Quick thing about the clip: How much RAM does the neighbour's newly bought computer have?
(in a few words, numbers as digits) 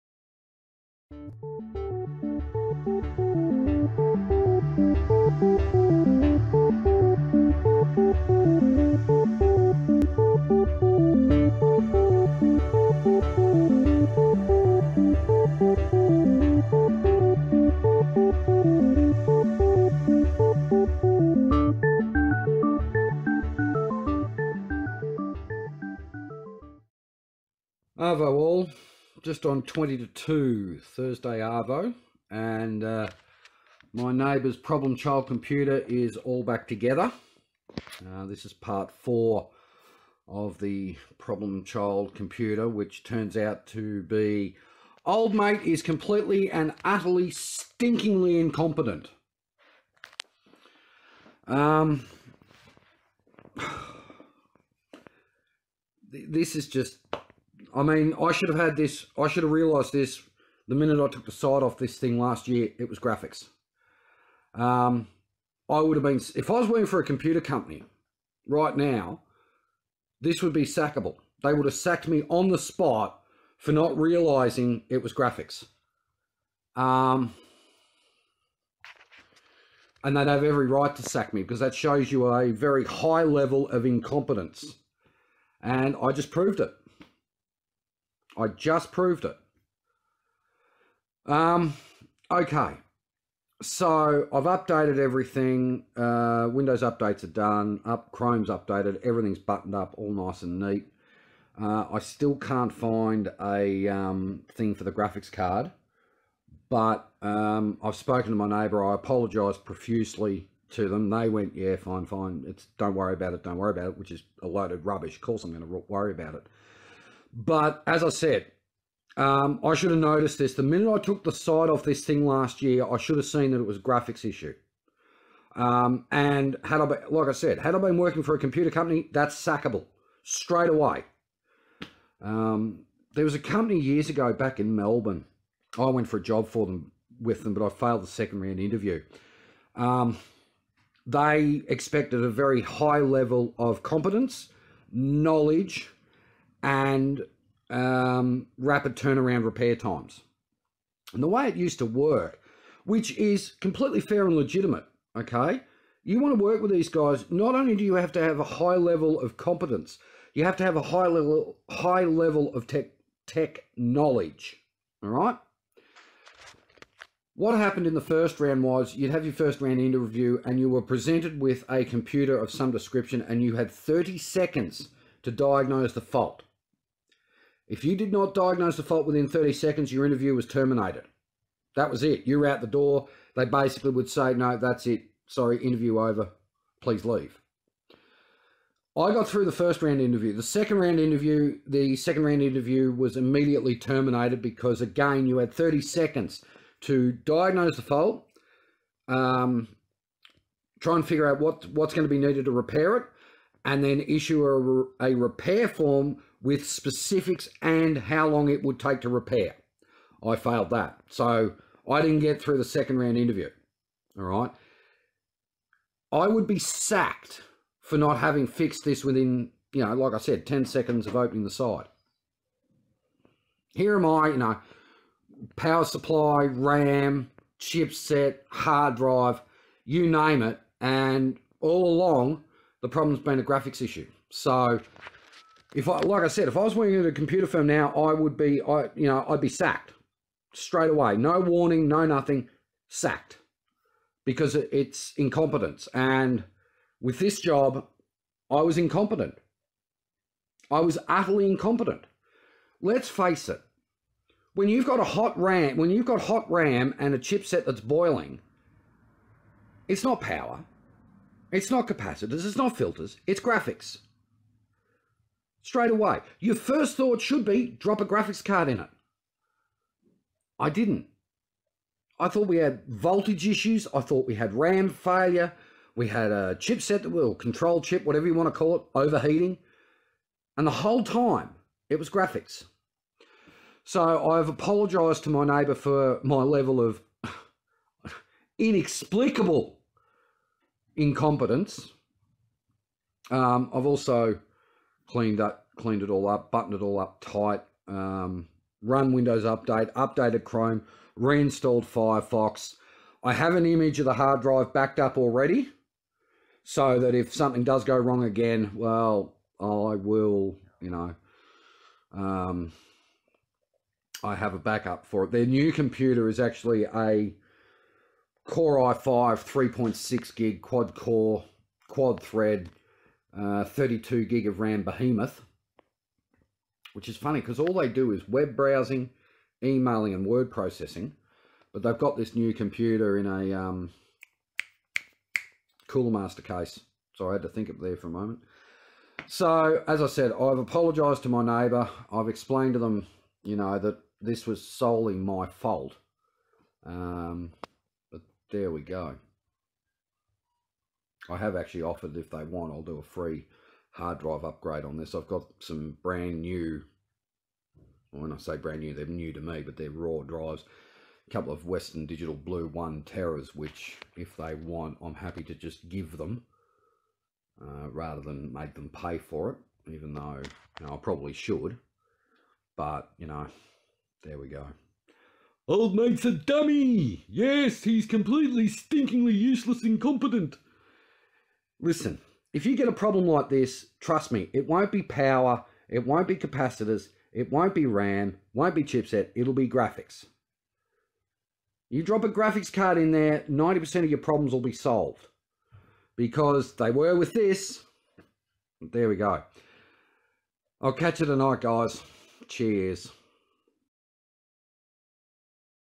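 32 GB.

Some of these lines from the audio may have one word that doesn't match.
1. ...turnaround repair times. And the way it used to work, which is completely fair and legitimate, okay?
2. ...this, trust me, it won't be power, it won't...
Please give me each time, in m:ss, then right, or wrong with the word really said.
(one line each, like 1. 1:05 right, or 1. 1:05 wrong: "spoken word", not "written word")
1. 2:28 right
2. 6:23 right.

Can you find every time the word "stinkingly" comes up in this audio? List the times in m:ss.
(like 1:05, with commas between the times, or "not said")
0:47, 6:18.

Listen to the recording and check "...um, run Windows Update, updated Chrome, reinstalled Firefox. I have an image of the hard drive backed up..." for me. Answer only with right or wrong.
right.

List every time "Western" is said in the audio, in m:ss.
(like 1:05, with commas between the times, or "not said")
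6:01.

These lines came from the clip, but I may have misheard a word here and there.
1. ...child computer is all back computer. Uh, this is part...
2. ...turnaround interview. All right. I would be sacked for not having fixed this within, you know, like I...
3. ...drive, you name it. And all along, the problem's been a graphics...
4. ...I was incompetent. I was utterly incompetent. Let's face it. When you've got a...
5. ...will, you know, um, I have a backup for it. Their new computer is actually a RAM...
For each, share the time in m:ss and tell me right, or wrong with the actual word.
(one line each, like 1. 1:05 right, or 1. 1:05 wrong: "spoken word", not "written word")
1. 0:34 wrong: "together", not "computer"
2. 3:32 wrong: "round", not "turnaround"
3. 3:48 right
4. 4:08 right
5. 5:09 wrong: "Core", not "RAM".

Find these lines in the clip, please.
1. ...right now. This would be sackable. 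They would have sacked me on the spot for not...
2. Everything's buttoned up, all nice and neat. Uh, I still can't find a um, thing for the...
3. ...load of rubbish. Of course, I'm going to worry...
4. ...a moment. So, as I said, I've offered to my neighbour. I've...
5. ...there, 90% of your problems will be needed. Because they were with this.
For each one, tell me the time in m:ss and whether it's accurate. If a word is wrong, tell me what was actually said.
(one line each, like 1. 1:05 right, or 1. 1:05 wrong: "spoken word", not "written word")
1. 1:08 right
2. 1:39 right
3. 1:54 right
4. 5:38 wrong: "apologised", not "offered"
5. 6:33 wrong: "solved", not "needed".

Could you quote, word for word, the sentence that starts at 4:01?
No warning, no nothing, sacked because it's incompetence.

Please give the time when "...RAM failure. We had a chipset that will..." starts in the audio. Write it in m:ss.
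4:34.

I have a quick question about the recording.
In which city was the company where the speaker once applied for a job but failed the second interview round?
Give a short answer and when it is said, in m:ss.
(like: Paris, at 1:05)
Melbourne, at 2:14.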